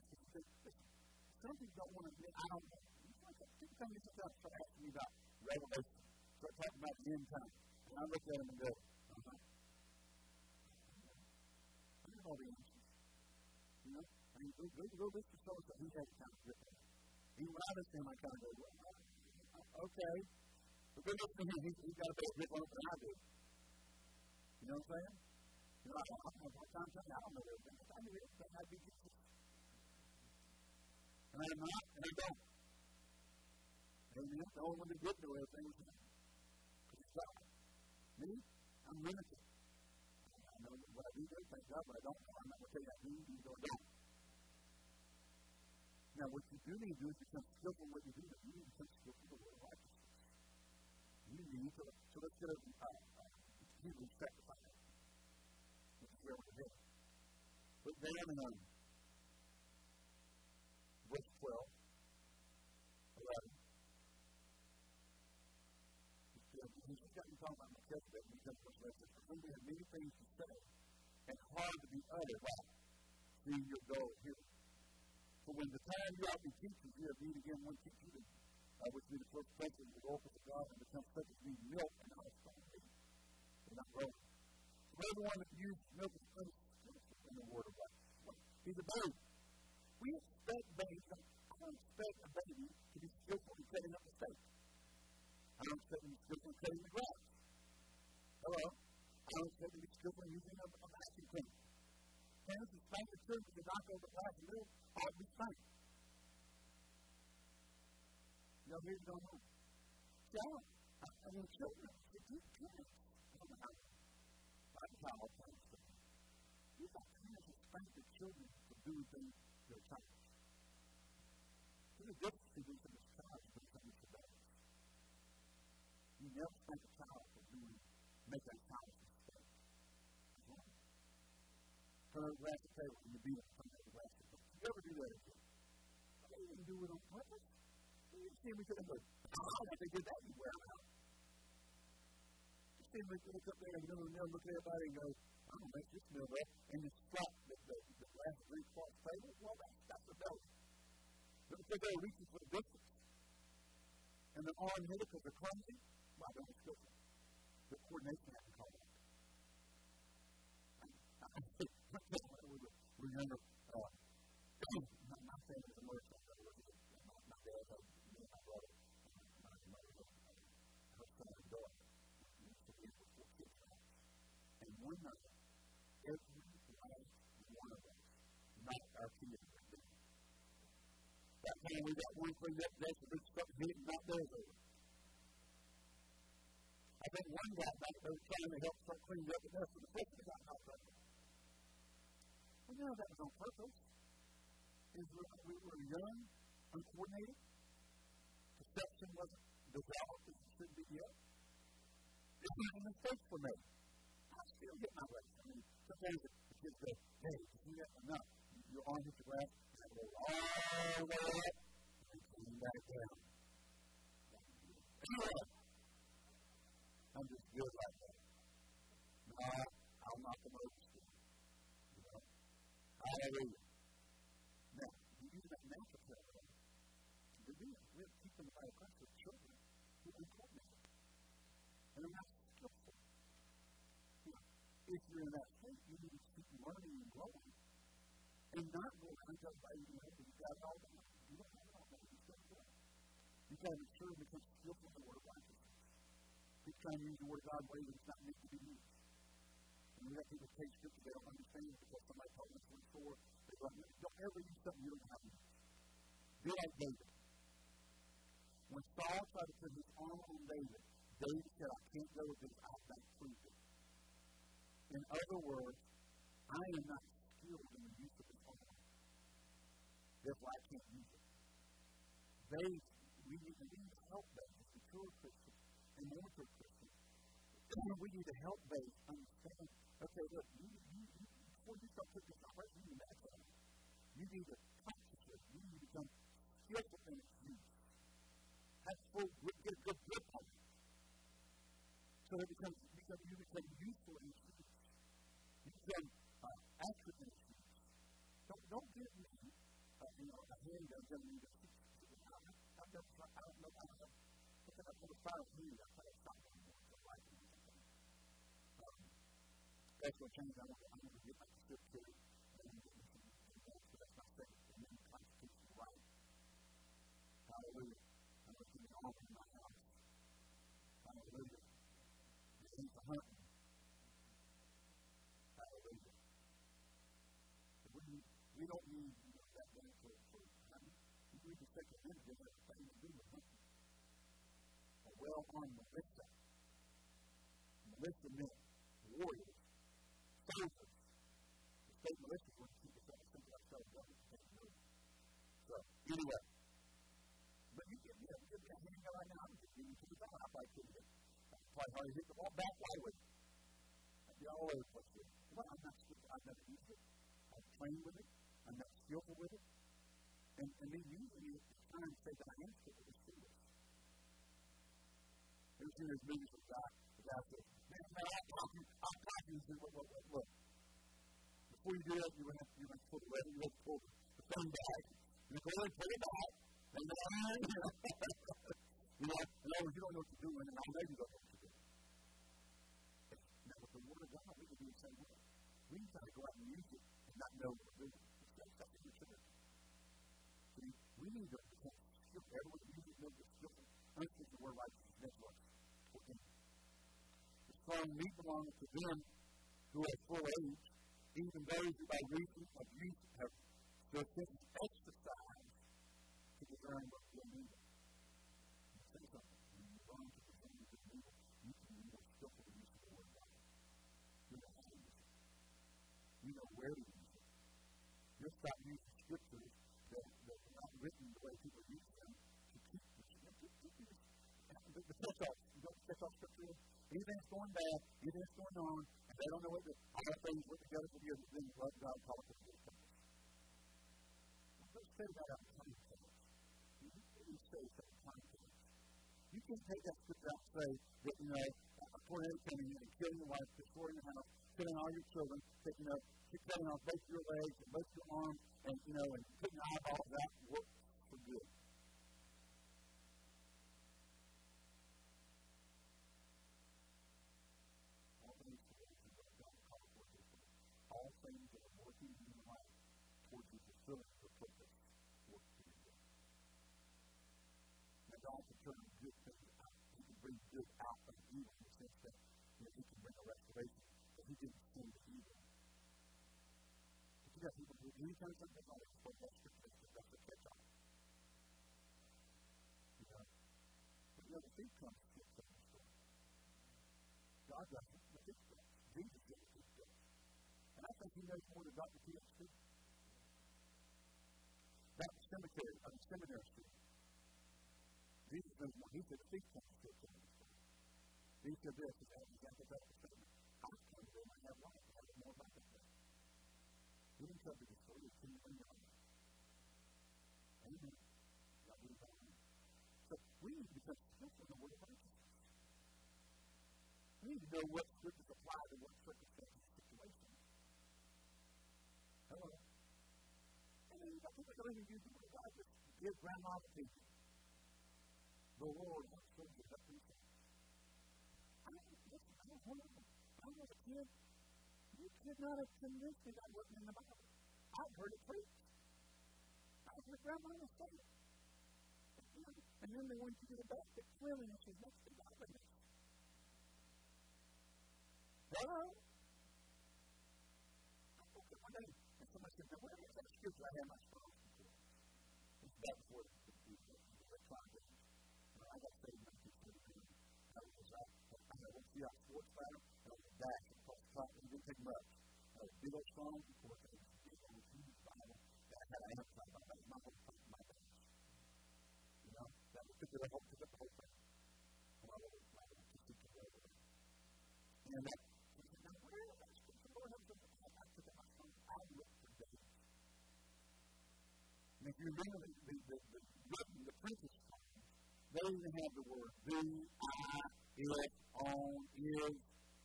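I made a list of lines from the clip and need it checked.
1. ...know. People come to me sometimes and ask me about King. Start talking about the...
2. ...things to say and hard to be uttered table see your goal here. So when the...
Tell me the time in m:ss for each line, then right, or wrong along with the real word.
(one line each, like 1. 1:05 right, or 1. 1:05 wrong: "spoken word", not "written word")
1. 0:02 wrong: "Revelation", not "King"
2. 1:09 wrong: "while", not "table".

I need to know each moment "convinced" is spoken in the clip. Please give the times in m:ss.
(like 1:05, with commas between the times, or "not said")
8:55.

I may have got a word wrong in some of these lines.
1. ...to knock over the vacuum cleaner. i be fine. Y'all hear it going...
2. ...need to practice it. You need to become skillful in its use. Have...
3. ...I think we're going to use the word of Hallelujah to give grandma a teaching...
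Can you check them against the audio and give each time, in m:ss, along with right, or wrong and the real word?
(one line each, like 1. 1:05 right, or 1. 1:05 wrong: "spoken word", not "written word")
1. 1:43 right
2. 4:44 right
3. 8:44 wrong: "God", not "Hallelujah".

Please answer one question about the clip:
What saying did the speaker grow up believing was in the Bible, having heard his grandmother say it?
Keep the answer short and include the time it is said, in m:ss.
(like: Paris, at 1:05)
cleanliness is next to godliness, at 9:04.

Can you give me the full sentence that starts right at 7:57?
But you have people who, anytime something like that, what that scripture is, that's a catch on.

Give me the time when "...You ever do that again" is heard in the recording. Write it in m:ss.
2:14.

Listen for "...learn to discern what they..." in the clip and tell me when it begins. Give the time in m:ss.
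6:50.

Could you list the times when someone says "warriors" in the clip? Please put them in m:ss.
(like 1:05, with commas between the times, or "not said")
5:39.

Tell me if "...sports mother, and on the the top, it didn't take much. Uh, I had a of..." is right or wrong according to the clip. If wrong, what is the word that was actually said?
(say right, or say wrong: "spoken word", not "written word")
wrong: "center", not "mother".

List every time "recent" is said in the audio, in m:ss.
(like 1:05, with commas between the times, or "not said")
not said.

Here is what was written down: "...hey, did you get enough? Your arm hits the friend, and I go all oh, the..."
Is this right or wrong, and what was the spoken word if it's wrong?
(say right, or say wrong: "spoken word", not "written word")
wrong: "ground", not "friend".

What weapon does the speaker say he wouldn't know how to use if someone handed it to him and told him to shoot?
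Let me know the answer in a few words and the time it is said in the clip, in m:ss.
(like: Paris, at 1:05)
a handgun, at 5:00.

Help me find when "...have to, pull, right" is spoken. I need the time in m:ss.
6:12.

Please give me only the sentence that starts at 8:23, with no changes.
I come to them, I have life, I don't know about that.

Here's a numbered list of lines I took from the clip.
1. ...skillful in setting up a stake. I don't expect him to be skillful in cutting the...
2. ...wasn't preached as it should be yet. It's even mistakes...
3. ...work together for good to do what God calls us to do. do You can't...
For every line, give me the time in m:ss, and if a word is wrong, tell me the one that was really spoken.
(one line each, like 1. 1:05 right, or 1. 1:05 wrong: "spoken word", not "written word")
1. 1:33 right
2. 3:19 wrong: "developed", not "preached"
3. 7:10 right.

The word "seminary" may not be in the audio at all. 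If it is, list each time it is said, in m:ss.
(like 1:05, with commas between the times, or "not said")
8:16.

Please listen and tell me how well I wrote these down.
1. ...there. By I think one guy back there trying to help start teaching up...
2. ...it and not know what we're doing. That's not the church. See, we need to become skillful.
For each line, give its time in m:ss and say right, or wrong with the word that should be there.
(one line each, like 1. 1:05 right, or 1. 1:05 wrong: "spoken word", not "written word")
1. 2:59 wrong: "cleaning", not "teaching"
2. 6:26 right.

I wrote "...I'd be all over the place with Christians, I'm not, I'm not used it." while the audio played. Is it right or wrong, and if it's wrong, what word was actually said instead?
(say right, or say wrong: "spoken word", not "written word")
wrong: "Well", not "Christians".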